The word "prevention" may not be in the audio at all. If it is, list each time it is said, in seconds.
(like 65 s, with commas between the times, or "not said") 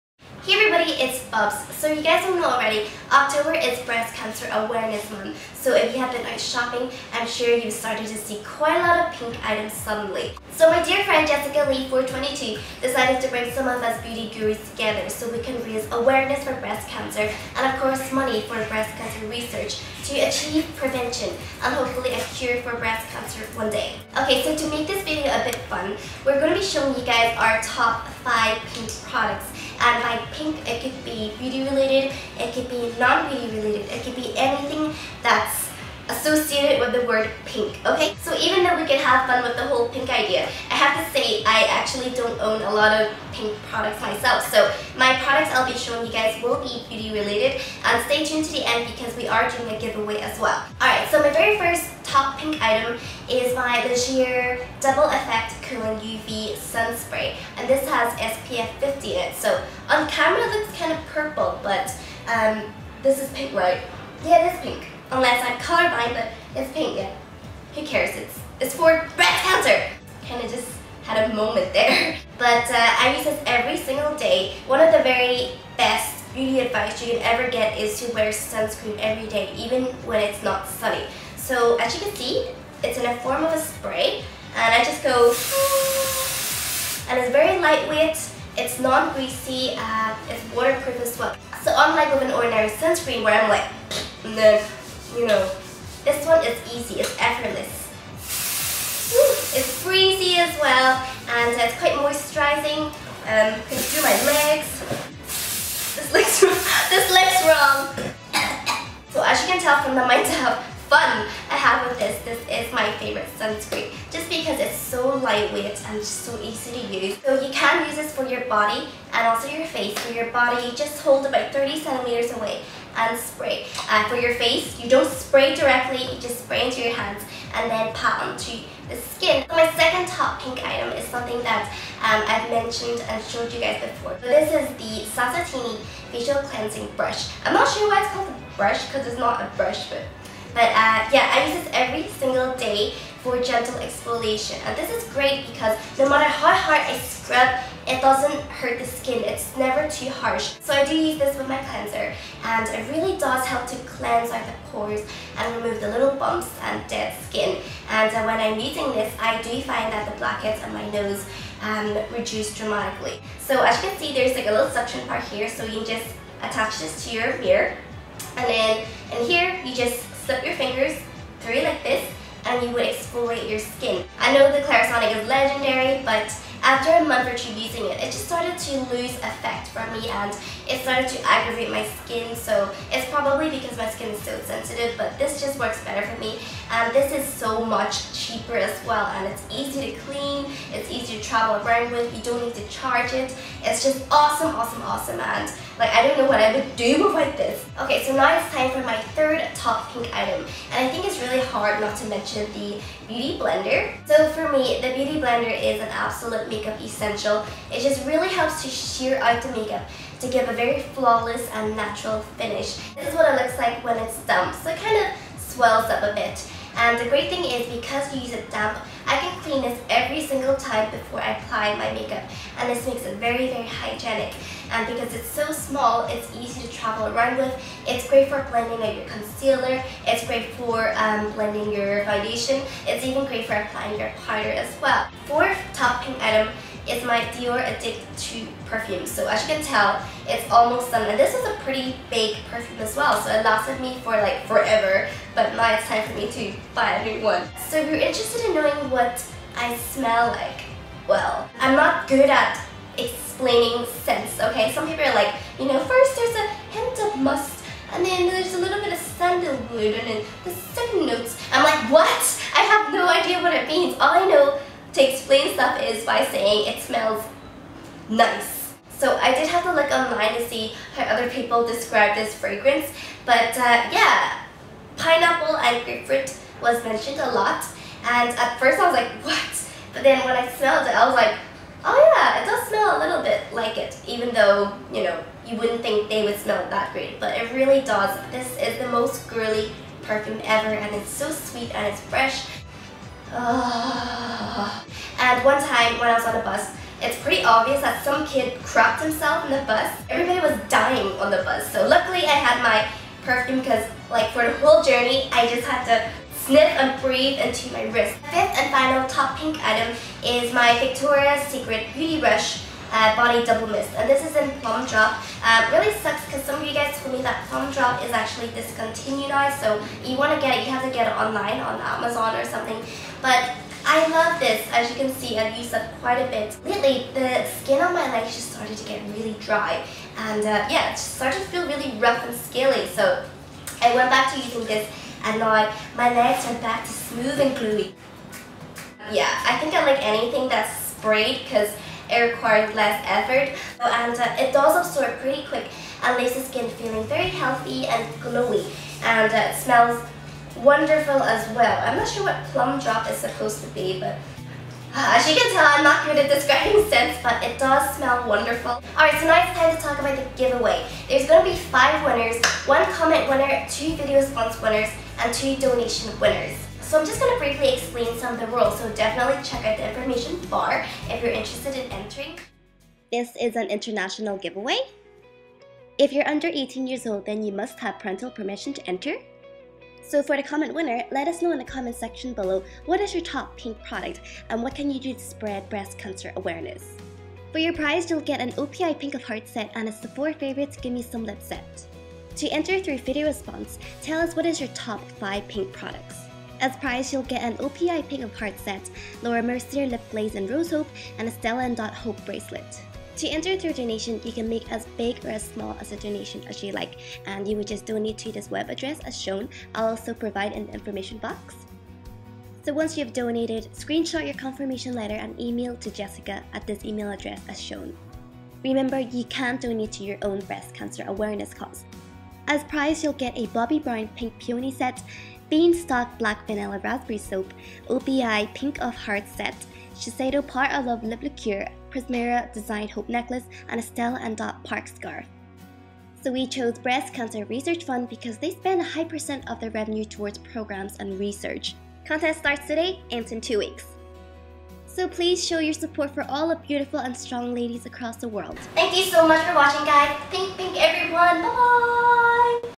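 20 s.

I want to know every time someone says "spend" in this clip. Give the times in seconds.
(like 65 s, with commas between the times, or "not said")
438 s.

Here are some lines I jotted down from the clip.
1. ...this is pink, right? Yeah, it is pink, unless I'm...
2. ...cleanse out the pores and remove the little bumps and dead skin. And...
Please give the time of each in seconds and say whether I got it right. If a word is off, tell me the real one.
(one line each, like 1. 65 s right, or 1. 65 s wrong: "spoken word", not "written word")
1. 63 s right
2. 153 s right.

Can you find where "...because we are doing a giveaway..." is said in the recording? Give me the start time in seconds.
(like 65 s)
48 s.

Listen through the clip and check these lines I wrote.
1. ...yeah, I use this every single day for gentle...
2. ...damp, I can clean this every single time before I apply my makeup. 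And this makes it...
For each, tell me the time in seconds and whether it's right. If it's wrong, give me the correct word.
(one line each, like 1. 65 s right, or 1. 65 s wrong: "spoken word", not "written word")
1. 141 s right
2. 218 s right.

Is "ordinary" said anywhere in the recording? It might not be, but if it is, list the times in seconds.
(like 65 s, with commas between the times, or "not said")
92 s.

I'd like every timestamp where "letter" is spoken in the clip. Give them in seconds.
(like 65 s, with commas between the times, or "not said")
414 s.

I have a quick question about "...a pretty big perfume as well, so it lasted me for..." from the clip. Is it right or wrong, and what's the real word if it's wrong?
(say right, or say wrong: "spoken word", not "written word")
right.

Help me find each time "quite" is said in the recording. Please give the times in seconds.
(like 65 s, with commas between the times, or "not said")
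8 s, 101 s, 326 s.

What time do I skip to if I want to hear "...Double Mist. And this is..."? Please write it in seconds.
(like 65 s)
313 s.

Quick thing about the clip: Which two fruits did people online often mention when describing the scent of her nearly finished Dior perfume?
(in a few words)
pineapple and grapefruit.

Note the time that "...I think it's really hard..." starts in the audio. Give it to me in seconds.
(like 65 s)
200 s.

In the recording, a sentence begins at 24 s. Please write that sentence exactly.
Okay, so to make this video a bit fun, we're going to be showing you guys our top 5 pink products.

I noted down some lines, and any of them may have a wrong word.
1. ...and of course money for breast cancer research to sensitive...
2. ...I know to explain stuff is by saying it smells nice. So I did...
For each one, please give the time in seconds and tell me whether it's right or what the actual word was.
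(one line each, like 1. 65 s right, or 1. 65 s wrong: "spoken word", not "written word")
1. 17 s wrong: "achieve", not "sensitive"
2. 264 s right.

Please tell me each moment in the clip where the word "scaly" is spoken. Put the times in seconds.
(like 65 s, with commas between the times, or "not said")
332 s.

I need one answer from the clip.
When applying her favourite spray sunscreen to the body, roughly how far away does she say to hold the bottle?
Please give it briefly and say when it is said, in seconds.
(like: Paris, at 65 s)
30 centimetres, at 121 s.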